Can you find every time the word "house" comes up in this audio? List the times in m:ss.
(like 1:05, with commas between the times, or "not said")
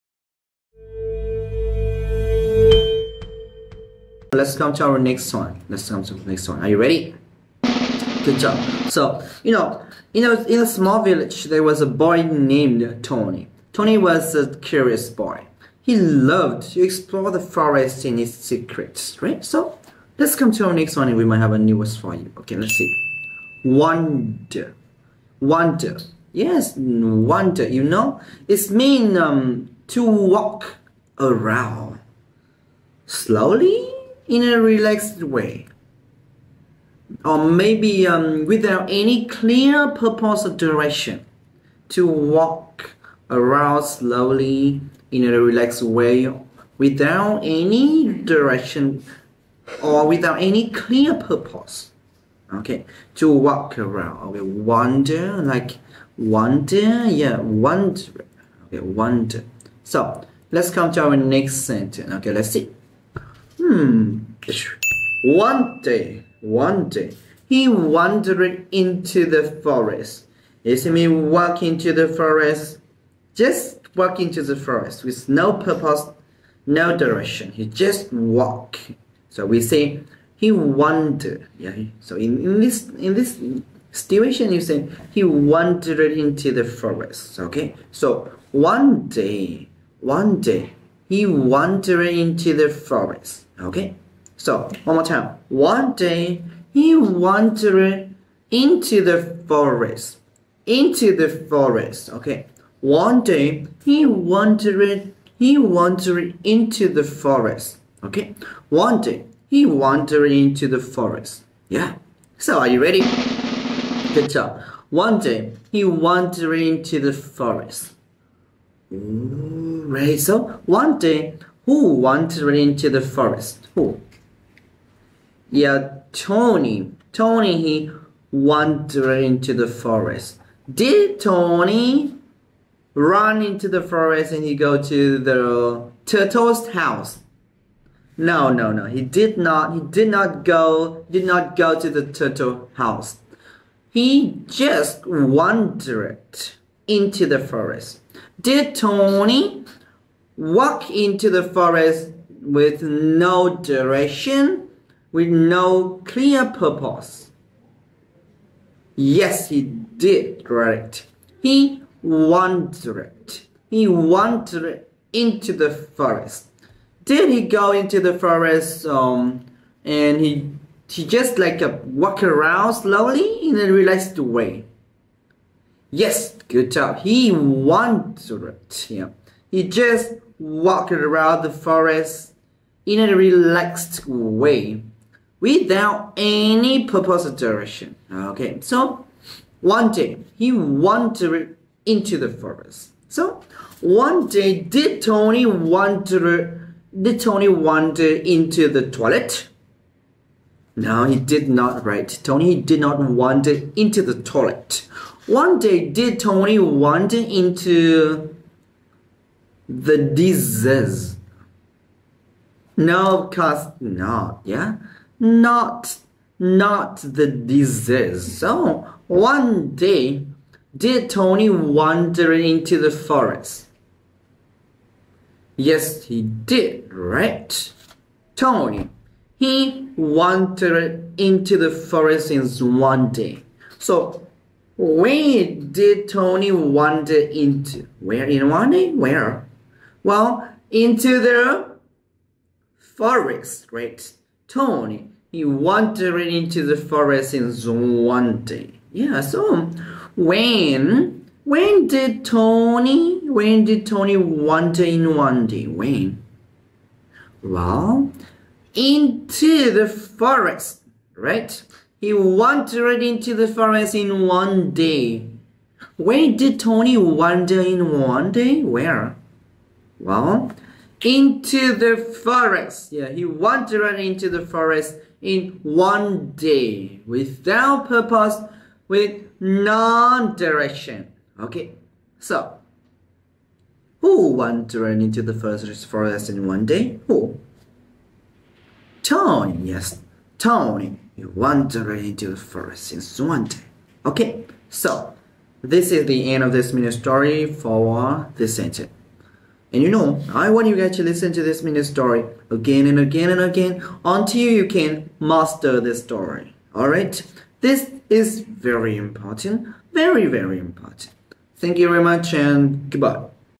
2:16, 2:22.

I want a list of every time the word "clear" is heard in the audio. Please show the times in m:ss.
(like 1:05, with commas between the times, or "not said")
0:39, 0:50, 2:36.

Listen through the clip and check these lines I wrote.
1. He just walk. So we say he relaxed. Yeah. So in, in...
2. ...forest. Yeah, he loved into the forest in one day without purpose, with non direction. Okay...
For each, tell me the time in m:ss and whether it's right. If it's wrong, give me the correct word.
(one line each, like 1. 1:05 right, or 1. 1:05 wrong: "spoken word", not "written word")
1. 1:17 wrong: "wandered", not "relaxed"
2. 4:32 wrong: "wandered", not "loved".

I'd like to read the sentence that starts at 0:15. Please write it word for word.
He loved to explore the forest and its secrets, right?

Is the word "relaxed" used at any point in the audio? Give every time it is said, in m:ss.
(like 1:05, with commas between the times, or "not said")
0:34, 0:45, 2:53, 3:03.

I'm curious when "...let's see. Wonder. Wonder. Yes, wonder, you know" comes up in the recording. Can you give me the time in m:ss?
0:22.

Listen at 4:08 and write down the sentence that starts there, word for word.
Yeah, so when when did Tony when did Tony wander in one day?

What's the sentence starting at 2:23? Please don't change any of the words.
He just wandered into the forest.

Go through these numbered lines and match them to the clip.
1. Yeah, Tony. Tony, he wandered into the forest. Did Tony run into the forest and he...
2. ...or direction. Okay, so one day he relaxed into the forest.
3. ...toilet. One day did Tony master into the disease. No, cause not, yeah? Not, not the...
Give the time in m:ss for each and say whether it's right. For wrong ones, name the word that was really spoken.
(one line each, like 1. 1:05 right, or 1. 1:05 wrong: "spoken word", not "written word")
1. 2:05 right
2. 3:07 wrong: "wandered", not "relaxed"
3. 3:24 wrong: "wander", not "master".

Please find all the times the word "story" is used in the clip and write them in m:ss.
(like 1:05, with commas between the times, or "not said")
4:56, 5:01, 5:06.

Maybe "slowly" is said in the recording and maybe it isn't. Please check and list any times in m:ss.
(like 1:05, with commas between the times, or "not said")
0:33, 0:43, 2:52.